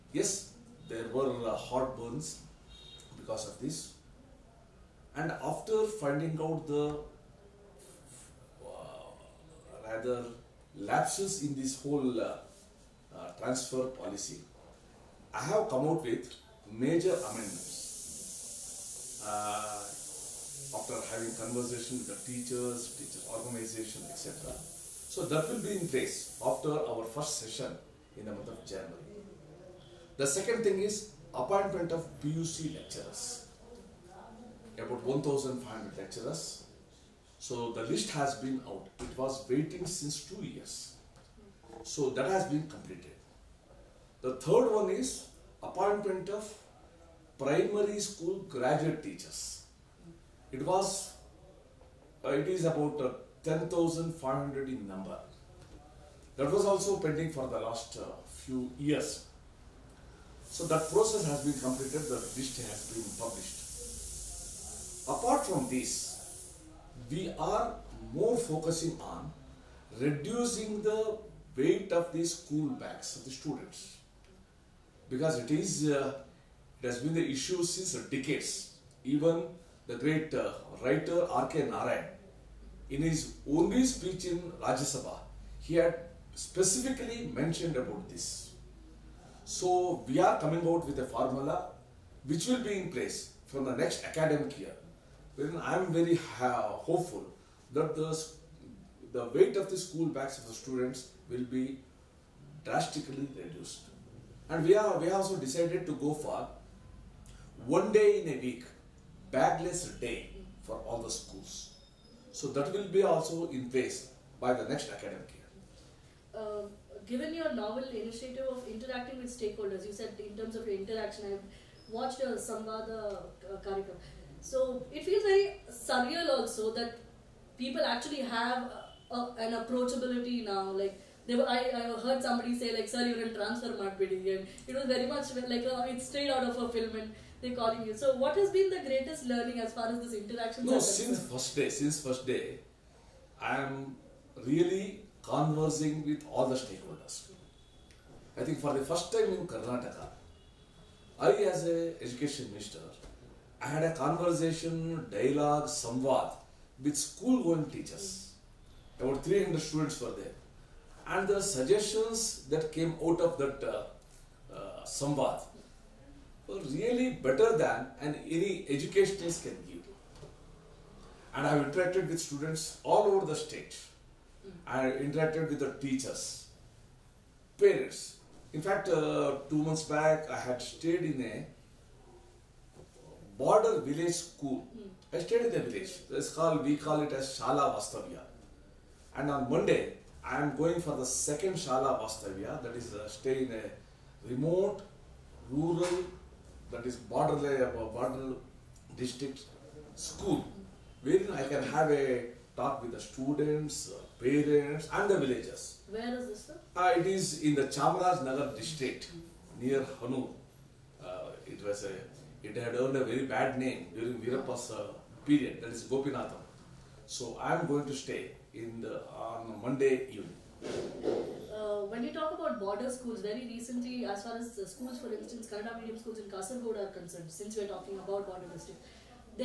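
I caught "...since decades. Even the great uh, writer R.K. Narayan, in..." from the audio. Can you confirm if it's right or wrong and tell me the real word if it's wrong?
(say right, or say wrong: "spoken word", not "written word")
right.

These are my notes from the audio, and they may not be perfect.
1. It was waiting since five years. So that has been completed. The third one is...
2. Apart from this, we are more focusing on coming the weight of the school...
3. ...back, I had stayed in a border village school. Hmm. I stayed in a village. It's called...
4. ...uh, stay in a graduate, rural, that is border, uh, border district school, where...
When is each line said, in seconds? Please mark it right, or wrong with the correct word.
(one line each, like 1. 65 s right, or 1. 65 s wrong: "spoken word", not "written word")
1. 38 s wrong: "two", not "five"
2. 65 s wrong: "reducing", not "coming"
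3. 179 s right
4. 192 s wrong: "remote", not "graduate".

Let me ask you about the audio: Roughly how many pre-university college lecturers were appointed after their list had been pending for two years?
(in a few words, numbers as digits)
1,500.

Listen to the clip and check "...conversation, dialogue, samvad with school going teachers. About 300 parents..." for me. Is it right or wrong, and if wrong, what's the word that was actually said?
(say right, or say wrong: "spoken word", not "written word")
wrong: "students", not "parents".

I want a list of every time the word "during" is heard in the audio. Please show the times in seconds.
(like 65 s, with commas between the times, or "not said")
213 s.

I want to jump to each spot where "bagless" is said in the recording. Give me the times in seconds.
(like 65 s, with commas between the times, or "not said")
109 s.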